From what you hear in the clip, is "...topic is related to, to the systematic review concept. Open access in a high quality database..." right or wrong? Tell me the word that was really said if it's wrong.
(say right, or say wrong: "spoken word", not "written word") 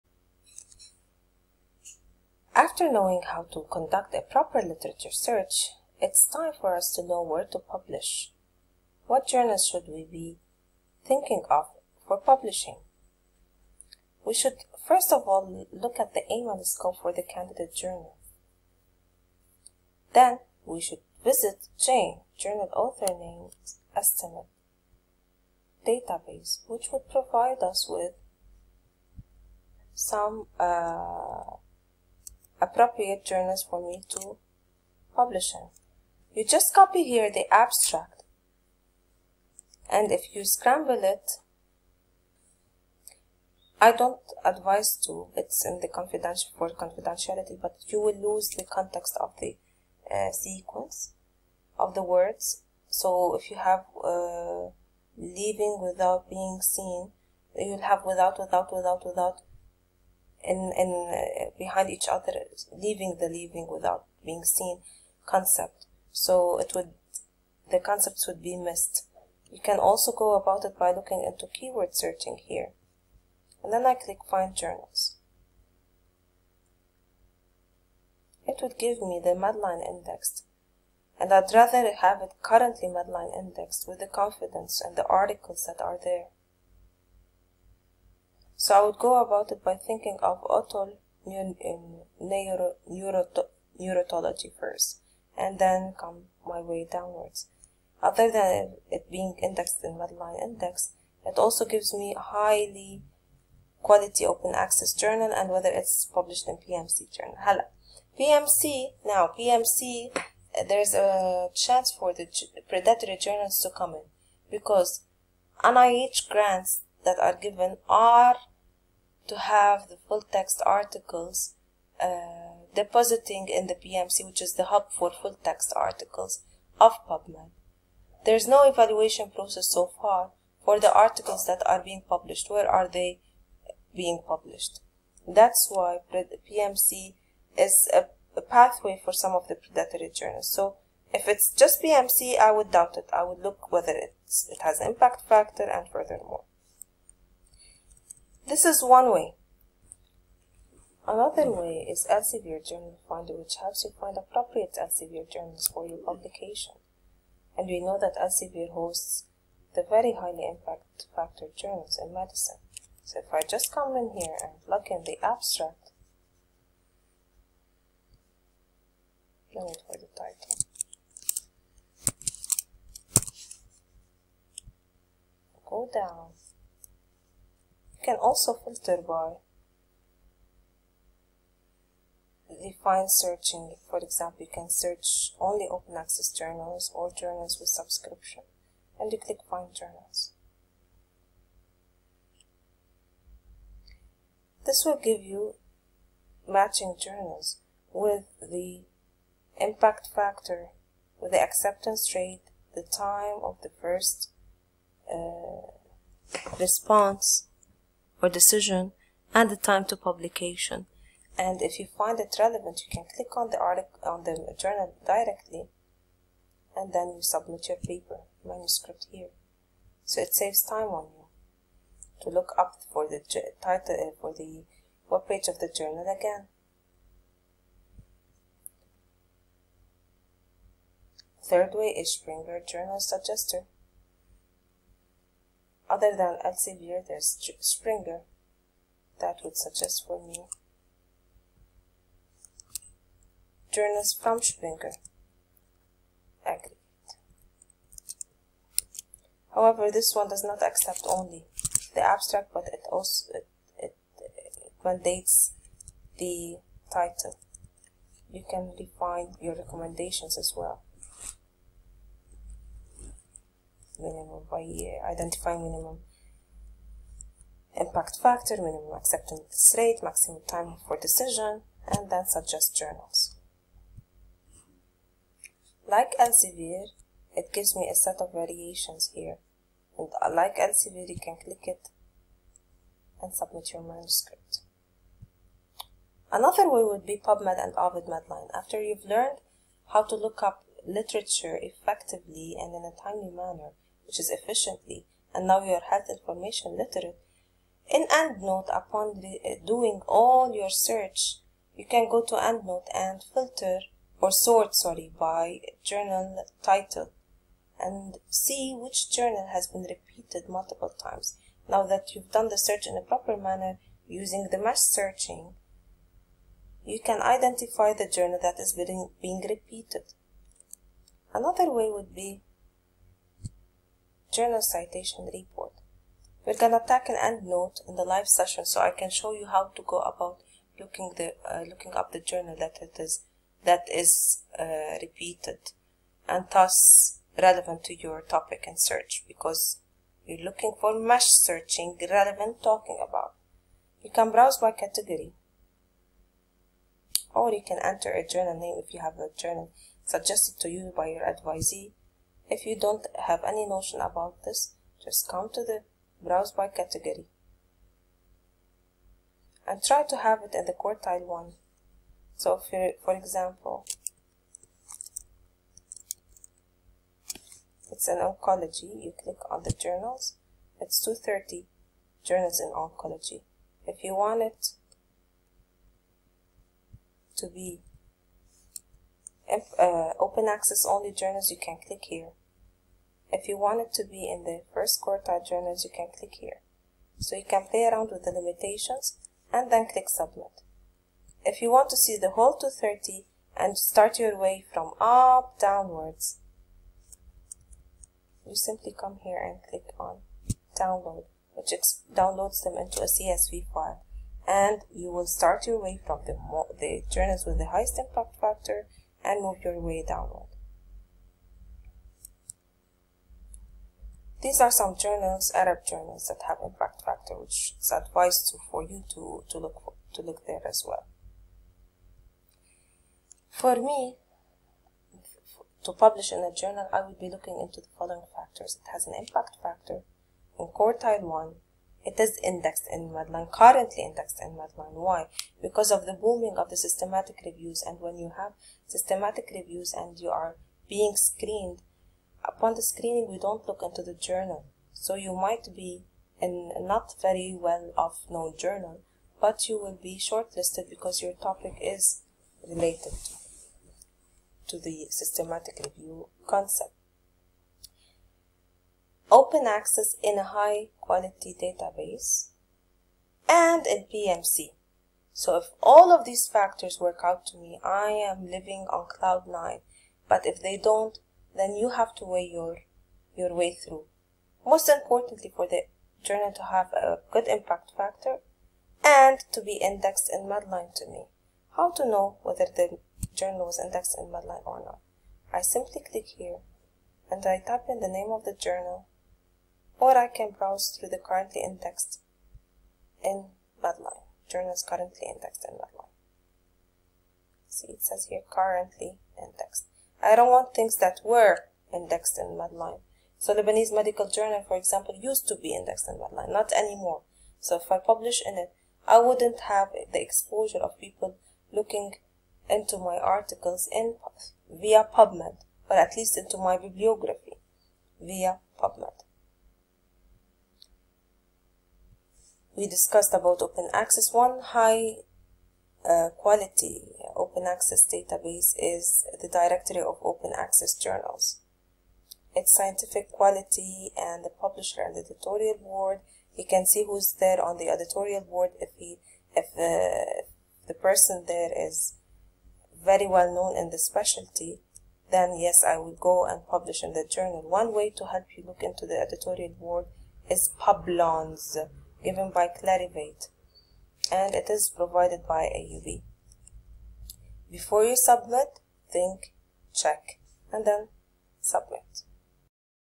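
right.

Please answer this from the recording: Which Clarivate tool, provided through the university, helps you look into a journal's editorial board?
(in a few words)
Publons.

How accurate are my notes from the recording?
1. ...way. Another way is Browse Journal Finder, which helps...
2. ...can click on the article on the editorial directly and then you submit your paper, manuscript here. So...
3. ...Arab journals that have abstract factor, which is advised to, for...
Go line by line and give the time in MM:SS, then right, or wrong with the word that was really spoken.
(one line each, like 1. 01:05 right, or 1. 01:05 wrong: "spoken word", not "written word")
1. 02:29 wrong: "Elsevier", not "Browse"
2. 03:32 wrong: "journal", not "editorial"
3. 06:55 wrong: "impact", not "abstract".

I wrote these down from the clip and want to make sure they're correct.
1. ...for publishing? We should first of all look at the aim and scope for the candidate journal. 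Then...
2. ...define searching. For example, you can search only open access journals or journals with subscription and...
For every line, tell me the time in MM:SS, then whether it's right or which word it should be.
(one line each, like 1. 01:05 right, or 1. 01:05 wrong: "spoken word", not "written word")
1. 00:12 right
2. 03:02 right.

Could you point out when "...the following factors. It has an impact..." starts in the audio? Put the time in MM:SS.
07:07.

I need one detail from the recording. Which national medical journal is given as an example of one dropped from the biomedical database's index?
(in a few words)
Lebanese Medical Journal.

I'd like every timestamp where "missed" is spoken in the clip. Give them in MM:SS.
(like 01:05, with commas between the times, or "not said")
01:08.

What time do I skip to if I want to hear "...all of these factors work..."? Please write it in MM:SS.
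07:45.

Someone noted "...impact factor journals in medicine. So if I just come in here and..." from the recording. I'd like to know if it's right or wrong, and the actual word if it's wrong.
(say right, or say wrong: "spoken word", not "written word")
right.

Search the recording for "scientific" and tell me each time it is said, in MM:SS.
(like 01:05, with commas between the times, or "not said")
08:52.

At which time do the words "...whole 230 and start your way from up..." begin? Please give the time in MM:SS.
06:32.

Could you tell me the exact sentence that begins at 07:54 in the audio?
Most importantly for the journal to have a good impact factor and to be indexed in Medline to me.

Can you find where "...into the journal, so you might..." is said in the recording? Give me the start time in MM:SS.
07:23.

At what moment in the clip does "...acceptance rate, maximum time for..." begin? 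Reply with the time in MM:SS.
04:28.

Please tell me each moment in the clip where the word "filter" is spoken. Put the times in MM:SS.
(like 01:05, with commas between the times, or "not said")
02:58, 05:03.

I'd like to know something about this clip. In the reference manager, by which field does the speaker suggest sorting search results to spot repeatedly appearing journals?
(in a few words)
journal title.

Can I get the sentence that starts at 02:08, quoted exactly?
There is no evaluation process so far for the articles that are being published.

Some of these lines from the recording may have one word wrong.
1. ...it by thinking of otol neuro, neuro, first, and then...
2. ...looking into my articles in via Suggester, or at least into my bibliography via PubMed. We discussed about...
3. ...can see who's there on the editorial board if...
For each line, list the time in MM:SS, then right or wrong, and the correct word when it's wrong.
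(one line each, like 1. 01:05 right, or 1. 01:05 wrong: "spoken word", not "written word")
1. 01:29 right
2. 08:31 wrong: "PubMed", not "Suggester"
3. 08:56 right.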